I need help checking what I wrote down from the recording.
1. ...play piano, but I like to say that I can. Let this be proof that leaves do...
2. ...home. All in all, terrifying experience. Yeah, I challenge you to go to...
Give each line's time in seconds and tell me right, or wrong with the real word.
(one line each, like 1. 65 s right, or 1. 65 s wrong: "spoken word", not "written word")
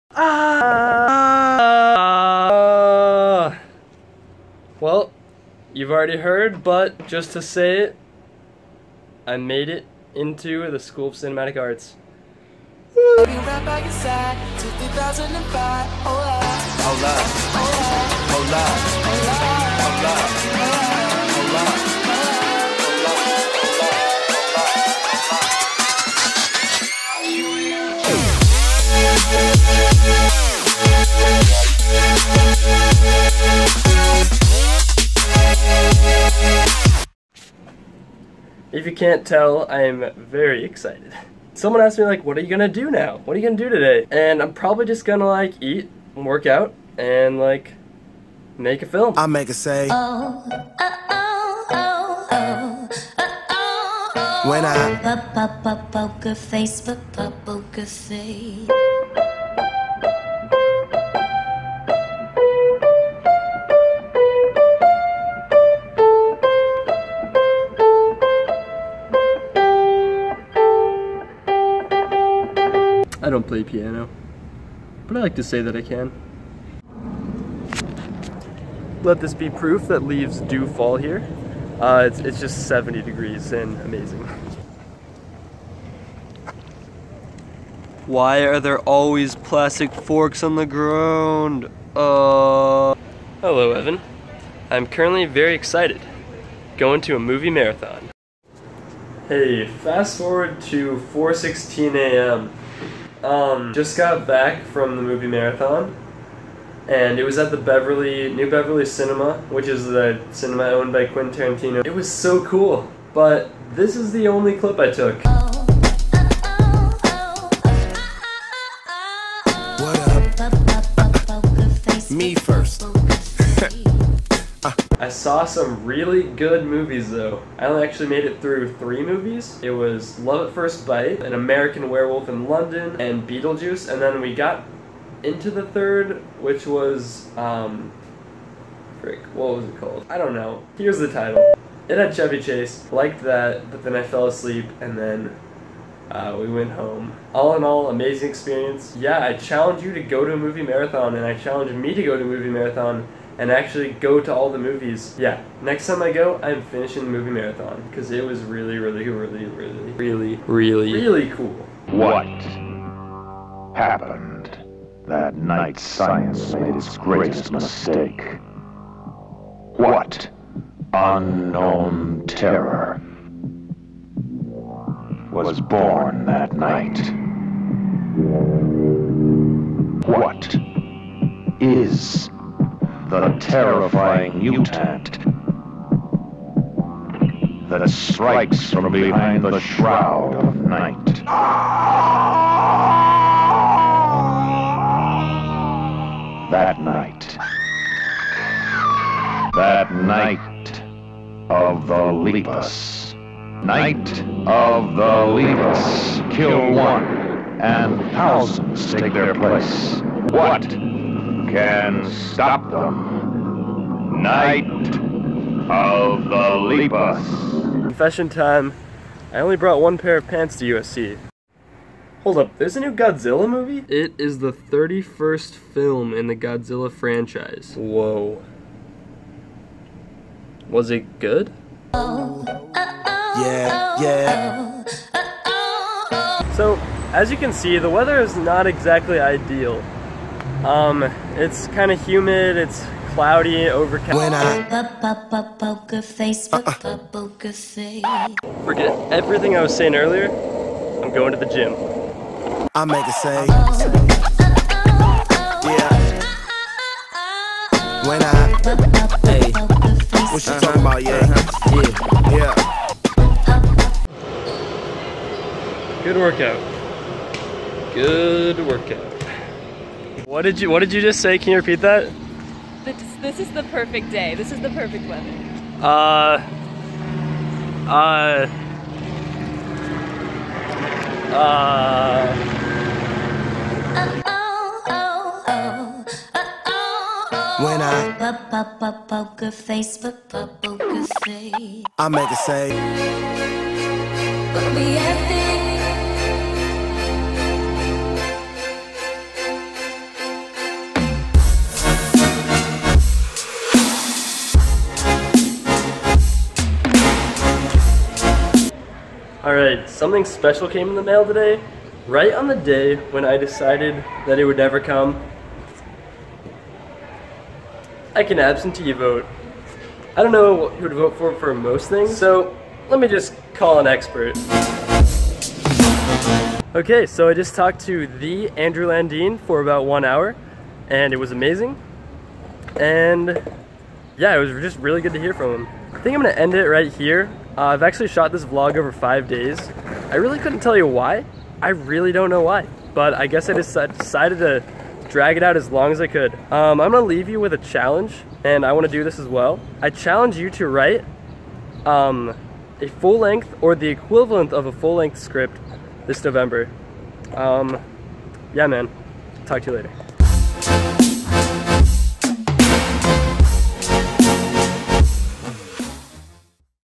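1. 73 s right
2. 146 s wrong: "amazing", not "terrifying".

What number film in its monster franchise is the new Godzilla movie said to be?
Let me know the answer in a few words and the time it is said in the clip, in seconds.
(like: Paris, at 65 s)
31st, at 224 s.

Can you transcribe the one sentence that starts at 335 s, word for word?
I think I'm gonna end it right here.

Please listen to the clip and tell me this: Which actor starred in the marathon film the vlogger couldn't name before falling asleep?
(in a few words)
Chevy Chase.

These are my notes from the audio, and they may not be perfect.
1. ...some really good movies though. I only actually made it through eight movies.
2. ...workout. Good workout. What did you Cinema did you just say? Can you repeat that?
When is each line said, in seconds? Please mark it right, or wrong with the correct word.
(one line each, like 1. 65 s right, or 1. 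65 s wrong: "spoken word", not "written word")
1. 125 s wrong: "three", not "eight"
2. 266 s wrong: "What", not "Cinema".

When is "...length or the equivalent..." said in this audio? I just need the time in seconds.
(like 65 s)
353 s.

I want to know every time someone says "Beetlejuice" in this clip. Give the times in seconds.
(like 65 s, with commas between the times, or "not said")
133 s.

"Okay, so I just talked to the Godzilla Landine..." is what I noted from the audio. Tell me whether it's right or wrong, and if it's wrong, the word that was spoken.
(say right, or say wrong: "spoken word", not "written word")
wrong: "Andrew", not "Godzilla".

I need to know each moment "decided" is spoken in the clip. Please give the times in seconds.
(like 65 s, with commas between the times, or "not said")
313 s, 343 s.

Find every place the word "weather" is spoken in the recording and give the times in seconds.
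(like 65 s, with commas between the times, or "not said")
237 s, 275 s.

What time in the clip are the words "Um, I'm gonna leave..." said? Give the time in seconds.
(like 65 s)
346 s.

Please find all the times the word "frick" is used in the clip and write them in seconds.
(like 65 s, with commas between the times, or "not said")
139 s.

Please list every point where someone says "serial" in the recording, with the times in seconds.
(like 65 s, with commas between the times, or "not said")
not said.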